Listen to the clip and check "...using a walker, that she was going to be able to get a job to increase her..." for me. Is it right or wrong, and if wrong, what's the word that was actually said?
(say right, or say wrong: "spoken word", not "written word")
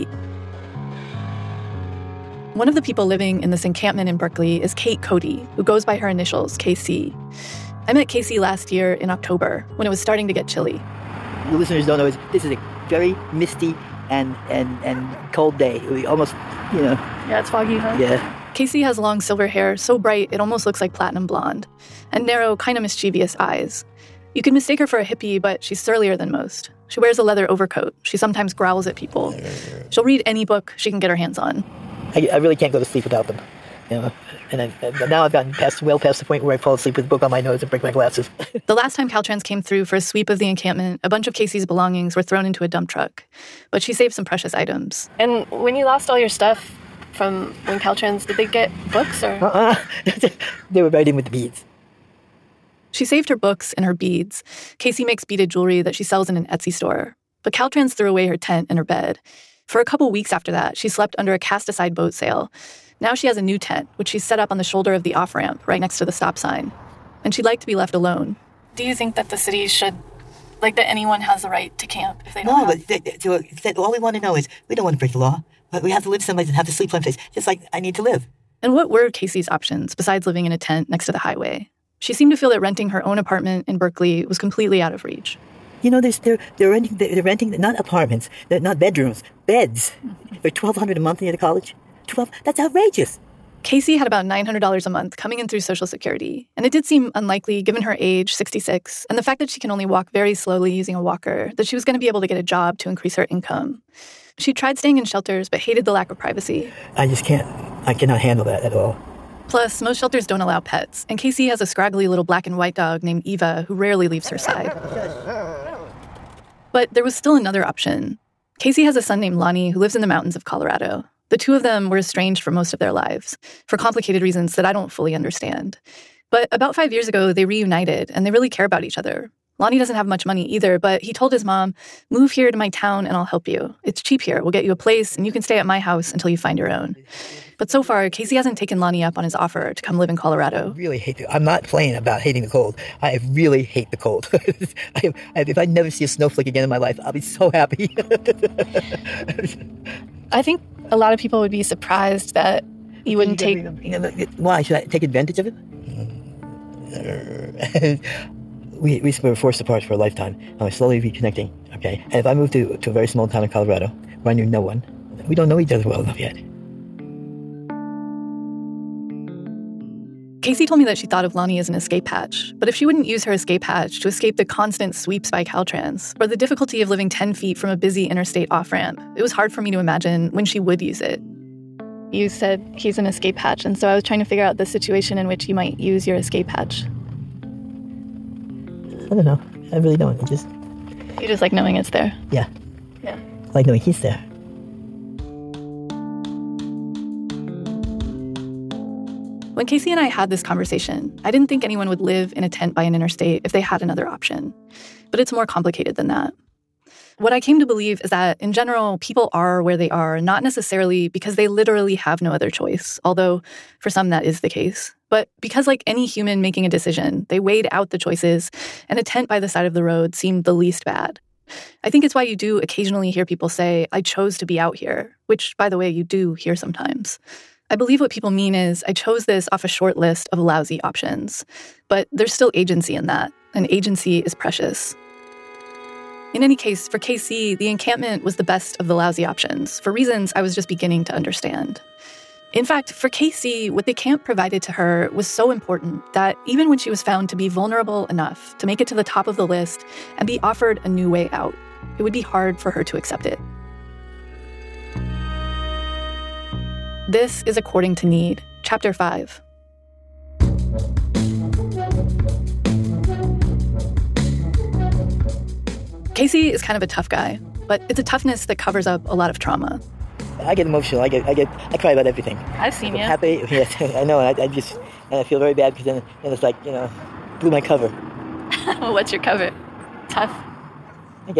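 right.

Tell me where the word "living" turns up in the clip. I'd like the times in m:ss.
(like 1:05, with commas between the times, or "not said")
0:03, 1:20, 2:56.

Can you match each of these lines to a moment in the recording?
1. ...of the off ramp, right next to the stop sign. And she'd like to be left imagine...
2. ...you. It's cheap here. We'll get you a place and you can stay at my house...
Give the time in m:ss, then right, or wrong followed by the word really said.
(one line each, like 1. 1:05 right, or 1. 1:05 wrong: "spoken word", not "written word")
1. 1:04 wrong: "alone", not "imagine"
2. 2:13 right.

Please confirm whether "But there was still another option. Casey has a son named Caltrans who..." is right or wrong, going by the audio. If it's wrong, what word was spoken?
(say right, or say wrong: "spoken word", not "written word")
wrong: "Lonnie", not "Caltrans".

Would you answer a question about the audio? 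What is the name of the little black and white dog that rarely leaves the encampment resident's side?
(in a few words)
Eva.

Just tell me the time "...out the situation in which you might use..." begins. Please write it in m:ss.
3:04.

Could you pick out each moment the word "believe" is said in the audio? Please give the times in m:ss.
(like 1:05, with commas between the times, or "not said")
3:27, 3:47.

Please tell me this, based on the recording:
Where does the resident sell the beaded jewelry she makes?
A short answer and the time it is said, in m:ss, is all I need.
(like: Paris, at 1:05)
Etsy, at 0:56.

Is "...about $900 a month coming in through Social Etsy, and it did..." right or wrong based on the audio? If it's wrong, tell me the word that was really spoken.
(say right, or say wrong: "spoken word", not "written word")
wrong: "Security", not "Etsy".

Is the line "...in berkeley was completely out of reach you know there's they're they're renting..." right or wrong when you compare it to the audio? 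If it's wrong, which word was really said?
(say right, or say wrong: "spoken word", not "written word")
right.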